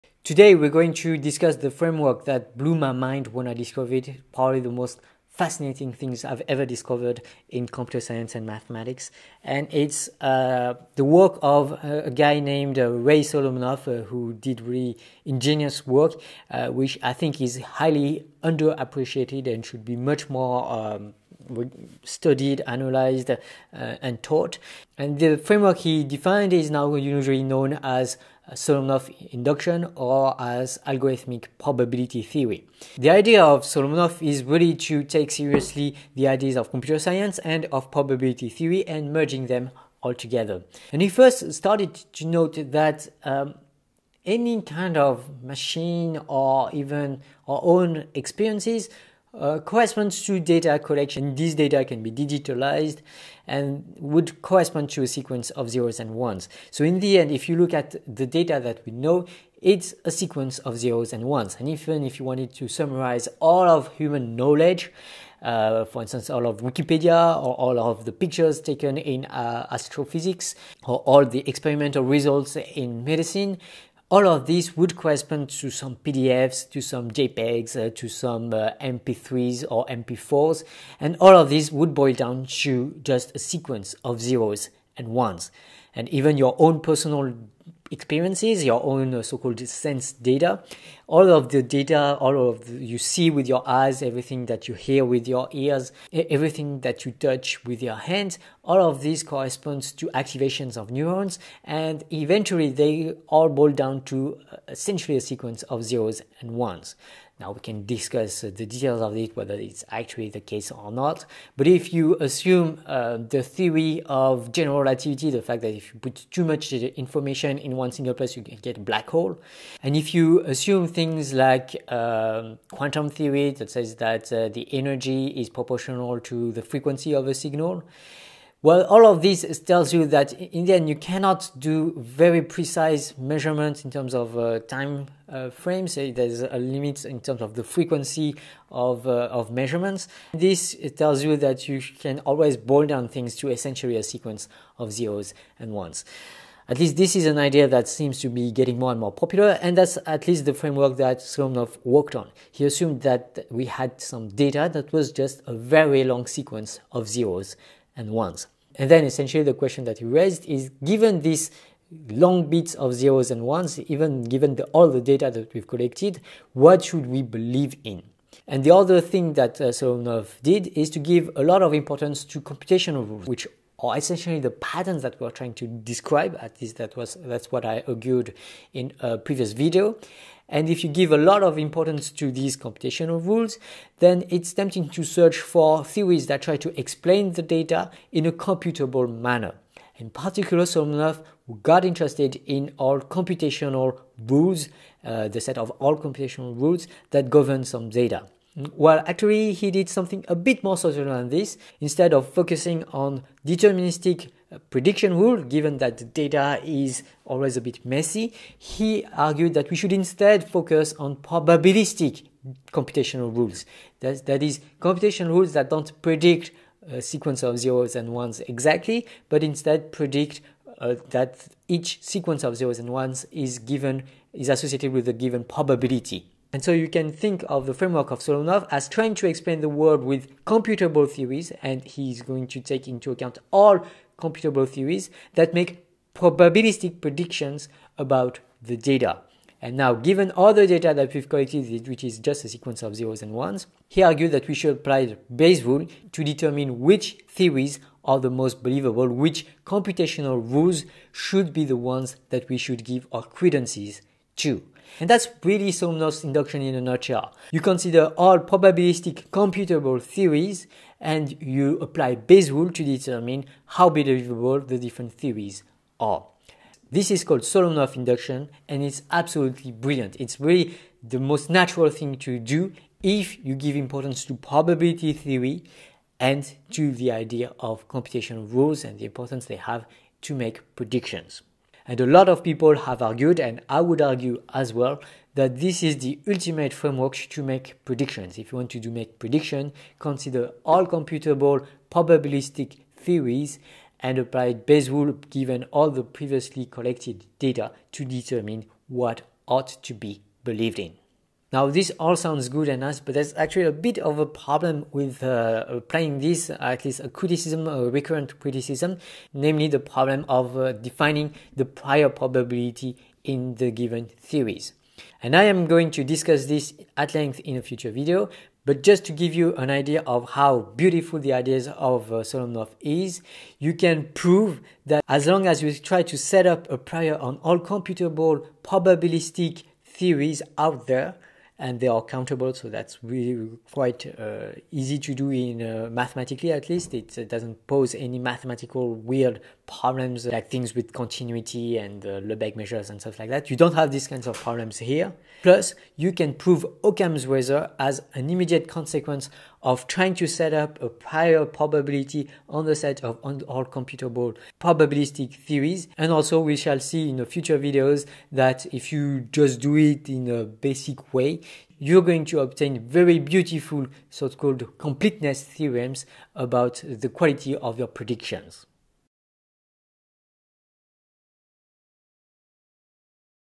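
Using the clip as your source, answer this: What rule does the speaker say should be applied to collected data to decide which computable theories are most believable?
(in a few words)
Bayes rule.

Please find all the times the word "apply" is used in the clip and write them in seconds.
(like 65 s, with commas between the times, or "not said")
244 s, 261 s, 294 s.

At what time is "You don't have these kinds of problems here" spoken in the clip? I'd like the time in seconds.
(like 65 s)
343 s.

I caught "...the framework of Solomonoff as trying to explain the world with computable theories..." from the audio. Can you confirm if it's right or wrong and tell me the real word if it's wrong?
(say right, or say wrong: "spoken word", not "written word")
right.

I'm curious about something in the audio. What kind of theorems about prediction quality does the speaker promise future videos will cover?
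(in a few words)
completeness theorems.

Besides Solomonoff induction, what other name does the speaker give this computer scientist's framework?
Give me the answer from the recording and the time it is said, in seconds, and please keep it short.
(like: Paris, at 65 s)
algorithmic probability theory, at 30 s.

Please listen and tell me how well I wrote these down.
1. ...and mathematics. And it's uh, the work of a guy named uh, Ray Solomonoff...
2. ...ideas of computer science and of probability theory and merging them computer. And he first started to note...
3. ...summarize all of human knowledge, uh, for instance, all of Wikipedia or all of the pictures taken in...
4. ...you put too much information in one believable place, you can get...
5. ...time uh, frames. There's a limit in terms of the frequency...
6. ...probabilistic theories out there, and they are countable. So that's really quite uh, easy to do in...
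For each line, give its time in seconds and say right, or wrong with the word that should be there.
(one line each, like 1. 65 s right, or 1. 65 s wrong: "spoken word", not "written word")
1. 8 s right
2. 36 s wrong: "altogether", not "computer"
3. 62 s right
4. 115 s wrong: "single", not "believable"
5. 134 s right
6. 328 s right.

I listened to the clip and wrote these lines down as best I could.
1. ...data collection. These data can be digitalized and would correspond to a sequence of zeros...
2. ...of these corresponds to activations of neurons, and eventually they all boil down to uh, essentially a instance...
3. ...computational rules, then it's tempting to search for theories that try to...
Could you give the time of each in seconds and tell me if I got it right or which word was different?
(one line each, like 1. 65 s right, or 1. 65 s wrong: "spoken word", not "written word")
1. 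50 s right
2. 98 s wrong: "sequence", not "instance"
3. 182 s right.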